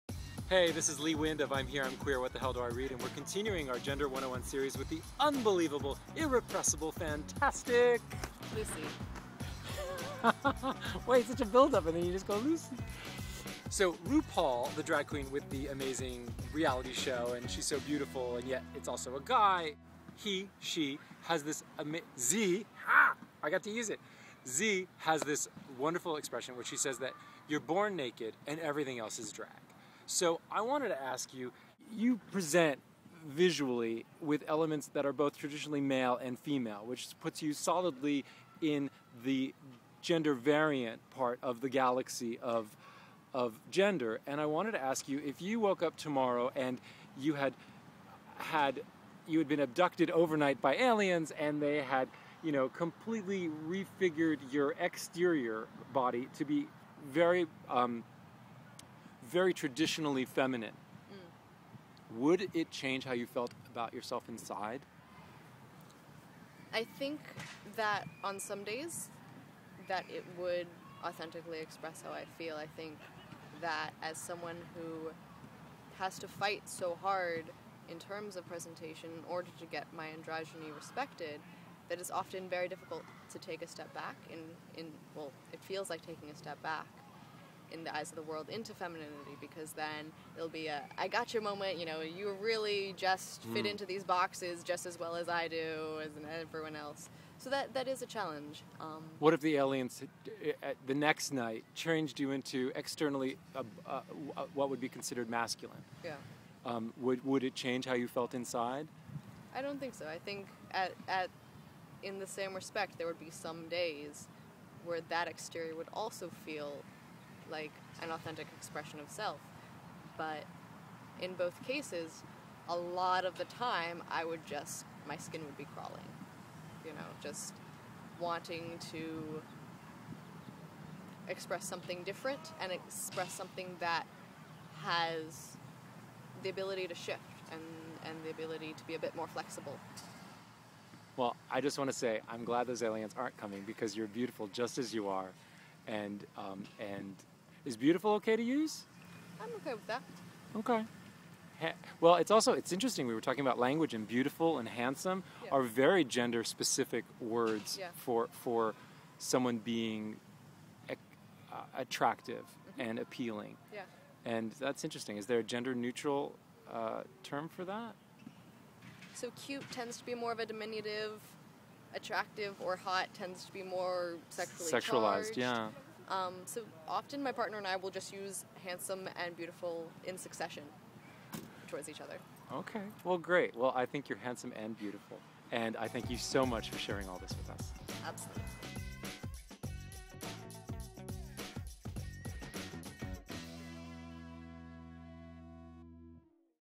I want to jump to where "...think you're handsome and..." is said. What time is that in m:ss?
3:03.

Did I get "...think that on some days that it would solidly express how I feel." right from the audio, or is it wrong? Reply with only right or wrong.
wrong.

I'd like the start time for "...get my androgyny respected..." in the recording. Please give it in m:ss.
1:19.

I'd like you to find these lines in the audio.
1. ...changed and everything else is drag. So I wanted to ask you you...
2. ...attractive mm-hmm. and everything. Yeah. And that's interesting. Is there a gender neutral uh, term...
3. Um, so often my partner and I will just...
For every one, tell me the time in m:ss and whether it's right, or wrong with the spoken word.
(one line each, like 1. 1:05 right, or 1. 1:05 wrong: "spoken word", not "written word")
1. 0:27 wrong: "naked", not "changed"
2. 2:41 wrong: "appealing", not "everything"
3. 2:56 right.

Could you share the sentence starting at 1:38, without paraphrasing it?
Um, what if the aliens uh, the next night changed you into externally uh, uh, what would be considered masculine?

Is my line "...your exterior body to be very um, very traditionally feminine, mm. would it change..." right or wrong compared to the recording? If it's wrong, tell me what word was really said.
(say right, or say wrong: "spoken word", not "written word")
right.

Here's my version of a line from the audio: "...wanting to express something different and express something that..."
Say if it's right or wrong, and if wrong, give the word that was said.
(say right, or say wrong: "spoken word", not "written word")
right.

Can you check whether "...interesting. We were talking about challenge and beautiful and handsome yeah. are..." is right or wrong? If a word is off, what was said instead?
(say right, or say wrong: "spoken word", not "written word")
wrong: "language", not "challenge".